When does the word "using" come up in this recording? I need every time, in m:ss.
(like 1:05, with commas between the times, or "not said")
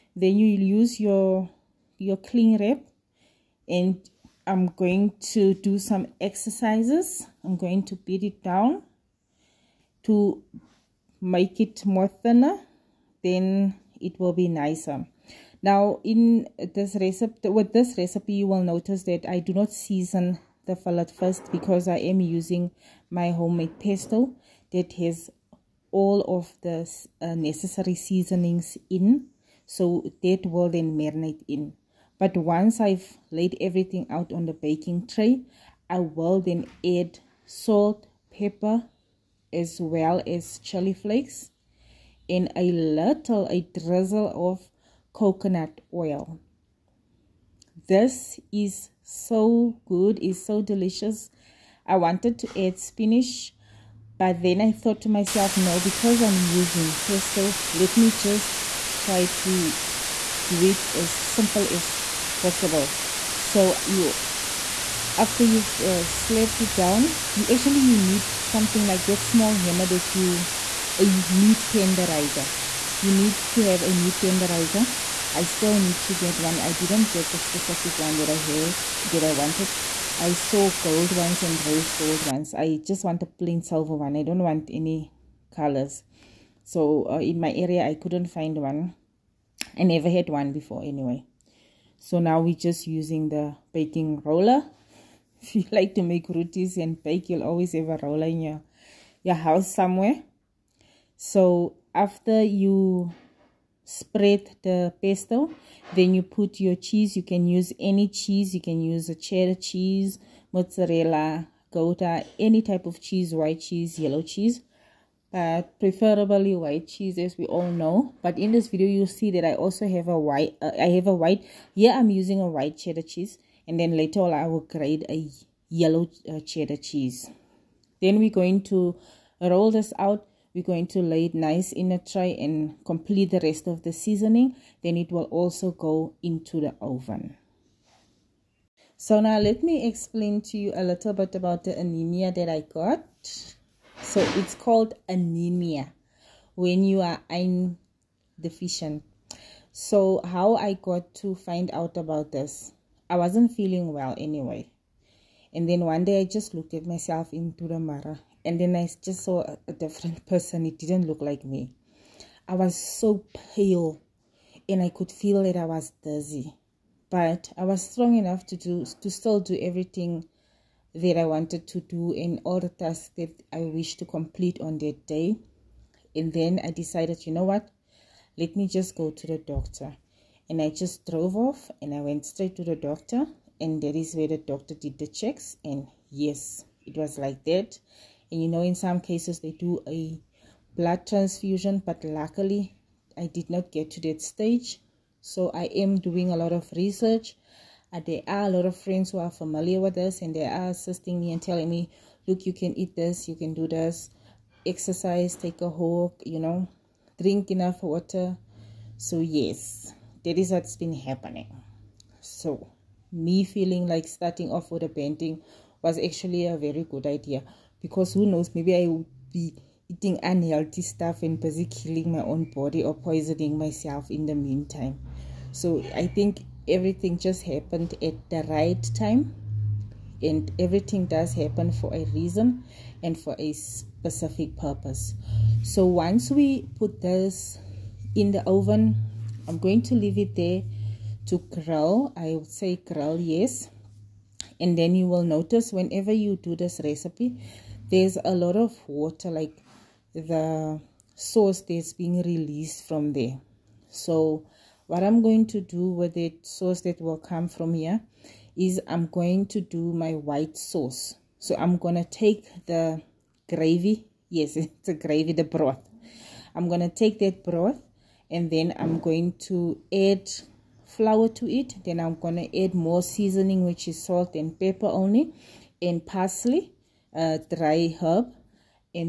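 0:22, 0:56, 1:32, 2:02.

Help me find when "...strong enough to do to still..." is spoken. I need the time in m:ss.
2:47.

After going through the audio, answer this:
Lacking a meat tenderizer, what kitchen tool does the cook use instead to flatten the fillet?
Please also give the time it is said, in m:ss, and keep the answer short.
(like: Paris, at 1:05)
baking roller, at 1:33.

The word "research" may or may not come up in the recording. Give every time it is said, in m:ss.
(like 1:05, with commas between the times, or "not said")
3:16.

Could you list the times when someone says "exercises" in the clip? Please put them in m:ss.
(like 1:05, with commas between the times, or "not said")
0:06, 3:24.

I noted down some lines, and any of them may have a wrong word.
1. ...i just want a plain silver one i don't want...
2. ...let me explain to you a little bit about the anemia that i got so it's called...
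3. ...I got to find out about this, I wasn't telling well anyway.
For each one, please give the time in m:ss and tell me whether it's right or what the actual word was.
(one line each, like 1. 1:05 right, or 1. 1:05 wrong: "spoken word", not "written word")
1. 1:22 right
2. 2:19 right
3. 2:30 wrong: "feeling", not "telling".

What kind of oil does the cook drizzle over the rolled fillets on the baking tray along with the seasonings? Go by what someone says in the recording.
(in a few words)
coconut oil.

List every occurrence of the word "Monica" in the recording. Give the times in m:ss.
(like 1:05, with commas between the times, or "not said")
not said.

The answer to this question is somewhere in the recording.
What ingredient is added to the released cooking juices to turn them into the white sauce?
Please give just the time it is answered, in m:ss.
4:30.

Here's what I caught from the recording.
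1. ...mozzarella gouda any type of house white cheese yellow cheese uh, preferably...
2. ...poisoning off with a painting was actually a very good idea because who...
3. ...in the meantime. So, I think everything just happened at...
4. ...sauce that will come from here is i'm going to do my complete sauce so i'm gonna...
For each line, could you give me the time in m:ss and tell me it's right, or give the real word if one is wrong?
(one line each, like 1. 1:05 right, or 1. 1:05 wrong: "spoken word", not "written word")
1. 1:50 wrong: "cheese", not "house"
2. 3:34 wrong: "starting", not "poisoning"
3. 3:44 right
4. 4:16 wrong: "white", not "complete".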